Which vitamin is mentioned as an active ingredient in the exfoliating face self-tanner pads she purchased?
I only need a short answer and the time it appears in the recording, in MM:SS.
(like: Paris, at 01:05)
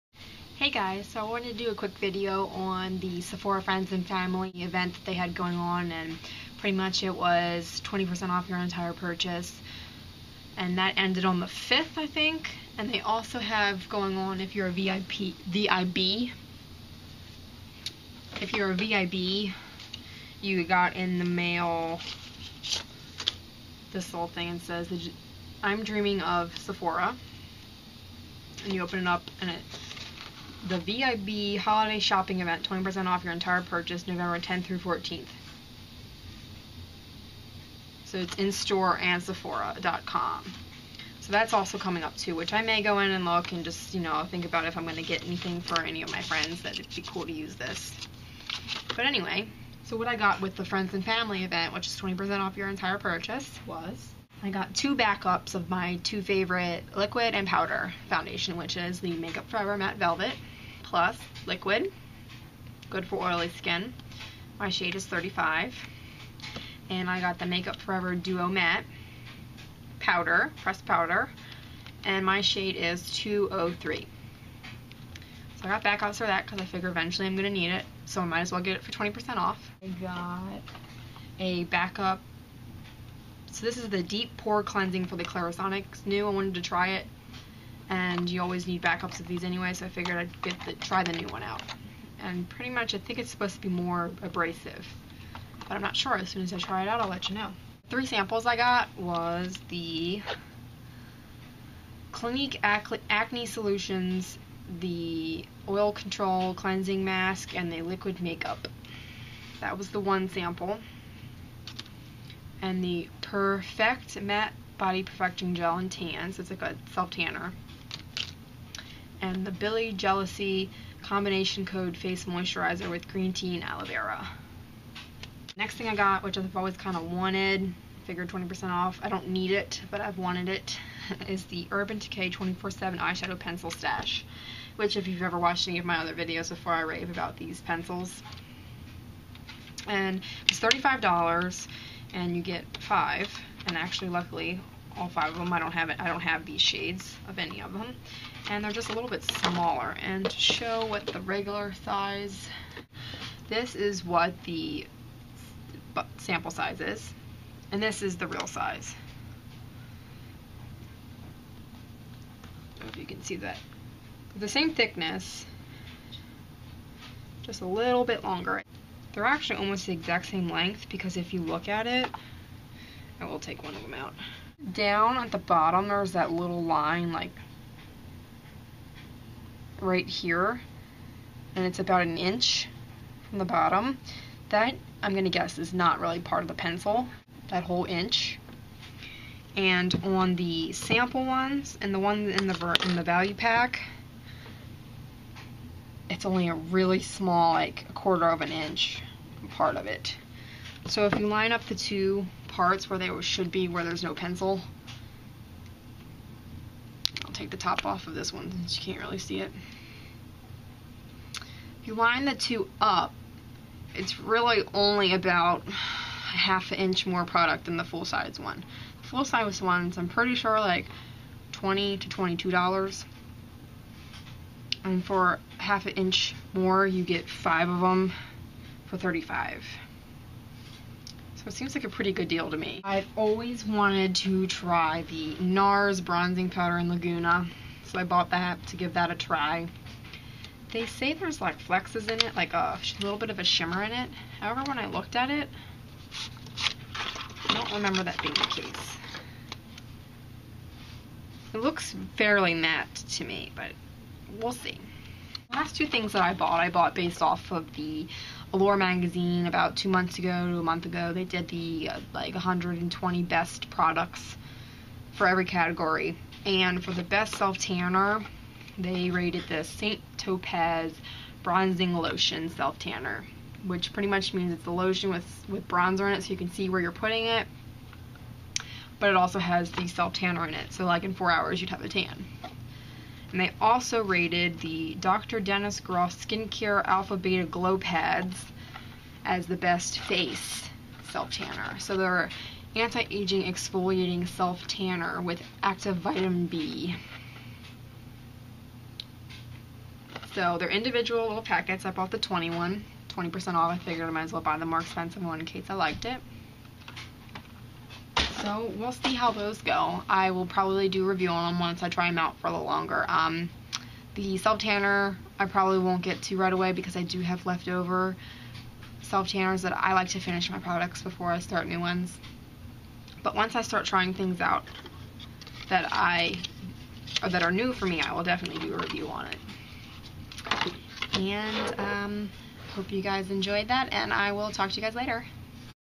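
vitamin B, at 04:55.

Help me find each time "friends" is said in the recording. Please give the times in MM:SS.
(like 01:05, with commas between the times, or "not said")
00:03, 00:46, 00:50.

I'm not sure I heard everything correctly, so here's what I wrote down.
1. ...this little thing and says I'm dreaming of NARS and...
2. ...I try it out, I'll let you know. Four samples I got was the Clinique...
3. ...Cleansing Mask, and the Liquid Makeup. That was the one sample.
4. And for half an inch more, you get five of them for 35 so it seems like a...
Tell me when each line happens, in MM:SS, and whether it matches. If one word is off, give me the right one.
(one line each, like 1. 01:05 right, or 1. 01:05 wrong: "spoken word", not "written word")
1. 00:23 wrong: "Sephora", not "NARS"
2. 01:36 wrong: "Three", not "Four"
3. 01:46 right
4. 03:44 right.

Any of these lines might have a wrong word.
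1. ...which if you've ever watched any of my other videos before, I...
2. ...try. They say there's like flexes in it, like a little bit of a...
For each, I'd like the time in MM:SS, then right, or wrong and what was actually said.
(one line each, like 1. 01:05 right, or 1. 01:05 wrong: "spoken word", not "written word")
1. 02:14 right
2. 03:59 right.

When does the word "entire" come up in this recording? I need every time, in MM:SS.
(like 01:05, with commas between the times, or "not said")
00:08, 00:33, 00:52.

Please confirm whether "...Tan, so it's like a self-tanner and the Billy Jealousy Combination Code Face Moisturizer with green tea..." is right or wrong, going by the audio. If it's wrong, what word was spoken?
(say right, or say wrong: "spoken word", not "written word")
right.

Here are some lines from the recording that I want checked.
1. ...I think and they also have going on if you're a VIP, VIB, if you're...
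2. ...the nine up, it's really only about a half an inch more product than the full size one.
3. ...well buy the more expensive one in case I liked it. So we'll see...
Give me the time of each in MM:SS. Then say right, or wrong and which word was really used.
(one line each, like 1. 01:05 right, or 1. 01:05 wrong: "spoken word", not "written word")
1. 00:11 right
2. 03:32 wrong: "two", not "nine"
3. 05:04 right.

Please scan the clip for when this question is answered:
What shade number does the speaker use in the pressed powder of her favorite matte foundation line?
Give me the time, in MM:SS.
01:13.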